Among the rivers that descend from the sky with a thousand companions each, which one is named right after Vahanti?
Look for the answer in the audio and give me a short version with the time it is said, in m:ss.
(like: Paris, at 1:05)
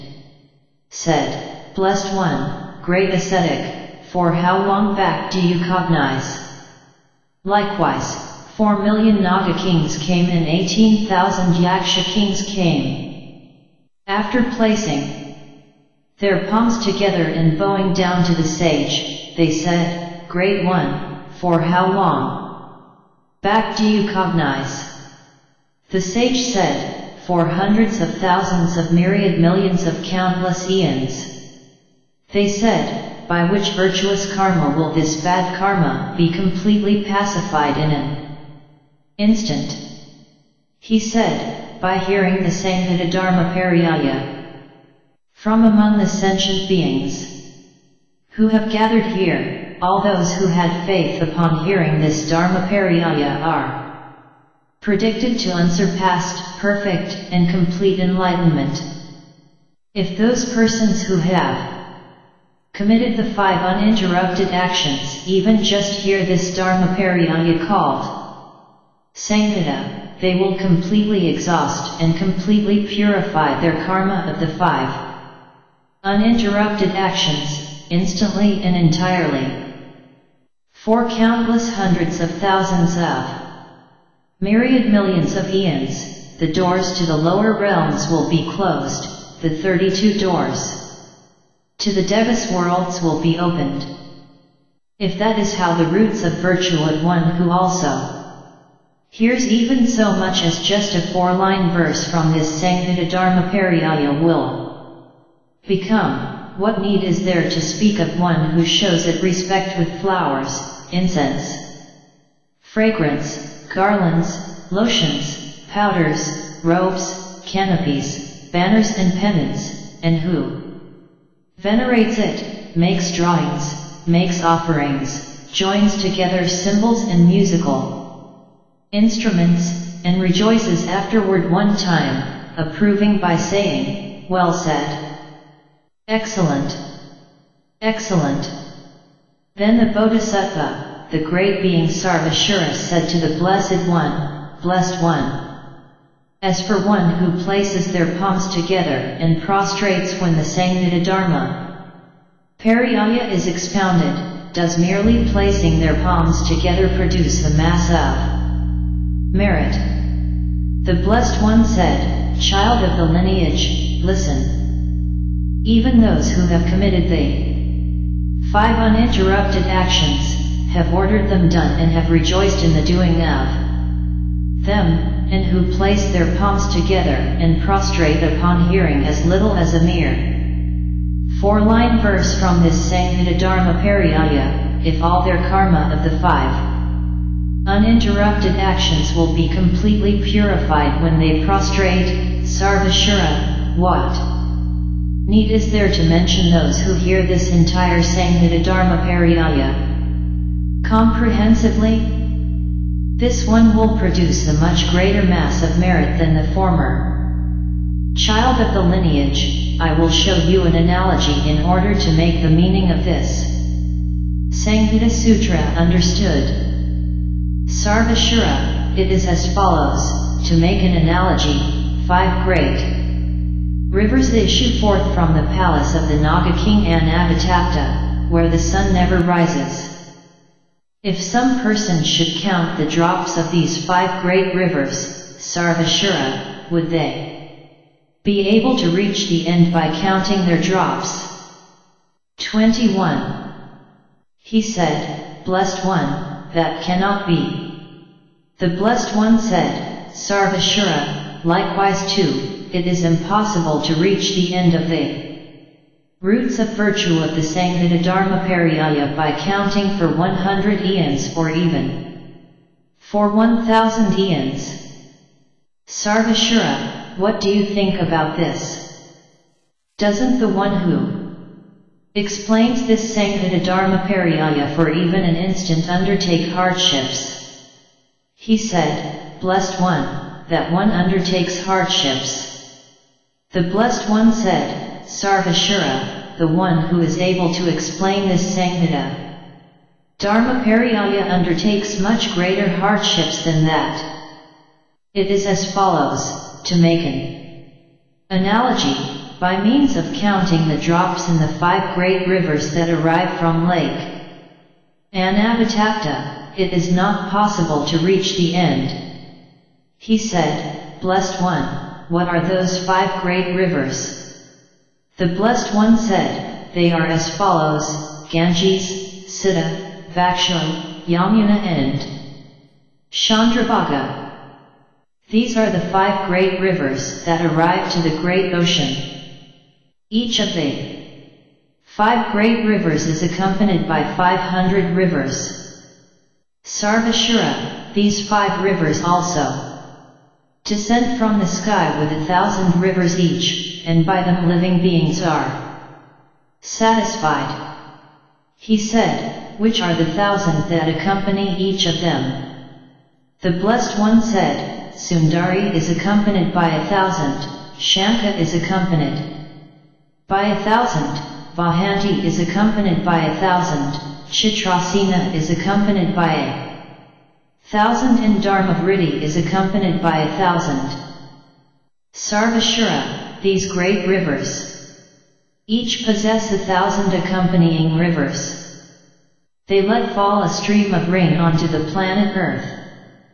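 Chitrasena, at 6:04.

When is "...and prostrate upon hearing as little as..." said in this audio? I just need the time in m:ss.
2:57.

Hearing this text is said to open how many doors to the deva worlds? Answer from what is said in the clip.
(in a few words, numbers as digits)
32.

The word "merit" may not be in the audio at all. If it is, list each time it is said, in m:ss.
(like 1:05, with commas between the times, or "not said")
2:39, 3:25.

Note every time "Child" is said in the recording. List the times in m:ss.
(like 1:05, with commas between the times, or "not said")
2:42, 3:28.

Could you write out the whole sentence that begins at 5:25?
These are the five great rivers that arrive to the great ocean.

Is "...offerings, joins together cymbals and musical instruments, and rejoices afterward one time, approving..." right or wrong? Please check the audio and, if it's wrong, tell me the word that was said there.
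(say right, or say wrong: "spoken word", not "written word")
right.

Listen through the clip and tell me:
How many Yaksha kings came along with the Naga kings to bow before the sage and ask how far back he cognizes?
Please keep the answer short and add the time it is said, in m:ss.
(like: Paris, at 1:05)
18,000, at 0:10.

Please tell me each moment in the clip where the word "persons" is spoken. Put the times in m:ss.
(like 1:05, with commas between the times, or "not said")
1:00, 3:51.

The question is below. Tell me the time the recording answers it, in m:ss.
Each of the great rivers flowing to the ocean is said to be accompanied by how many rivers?
5:34.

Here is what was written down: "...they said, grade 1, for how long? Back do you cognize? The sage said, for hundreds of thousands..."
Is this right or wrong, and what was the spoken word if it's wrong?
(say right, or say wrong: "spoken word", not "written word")
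right.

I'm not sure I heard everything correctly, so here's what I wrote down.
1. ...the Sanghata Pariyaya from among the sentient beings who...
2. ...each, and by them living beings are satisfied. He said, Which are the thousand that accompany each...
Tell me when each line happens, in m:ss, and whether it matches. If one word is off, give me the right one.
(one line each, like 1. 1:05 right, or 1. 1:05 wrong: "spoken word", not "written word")
1. 0:42 right
2. 5:43 right.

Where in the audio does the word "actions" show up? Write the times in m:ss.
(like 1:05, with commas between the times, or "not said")
1:04, 1:16, 2:49, 3:08.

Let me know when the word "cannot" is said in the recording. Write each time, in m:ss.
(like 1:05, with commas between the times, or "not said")
4:06.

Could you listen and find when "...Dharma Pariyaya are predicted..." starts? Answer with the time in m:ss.
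0:52.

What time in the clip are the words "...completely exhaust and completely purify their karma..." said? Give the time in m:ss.
1:10.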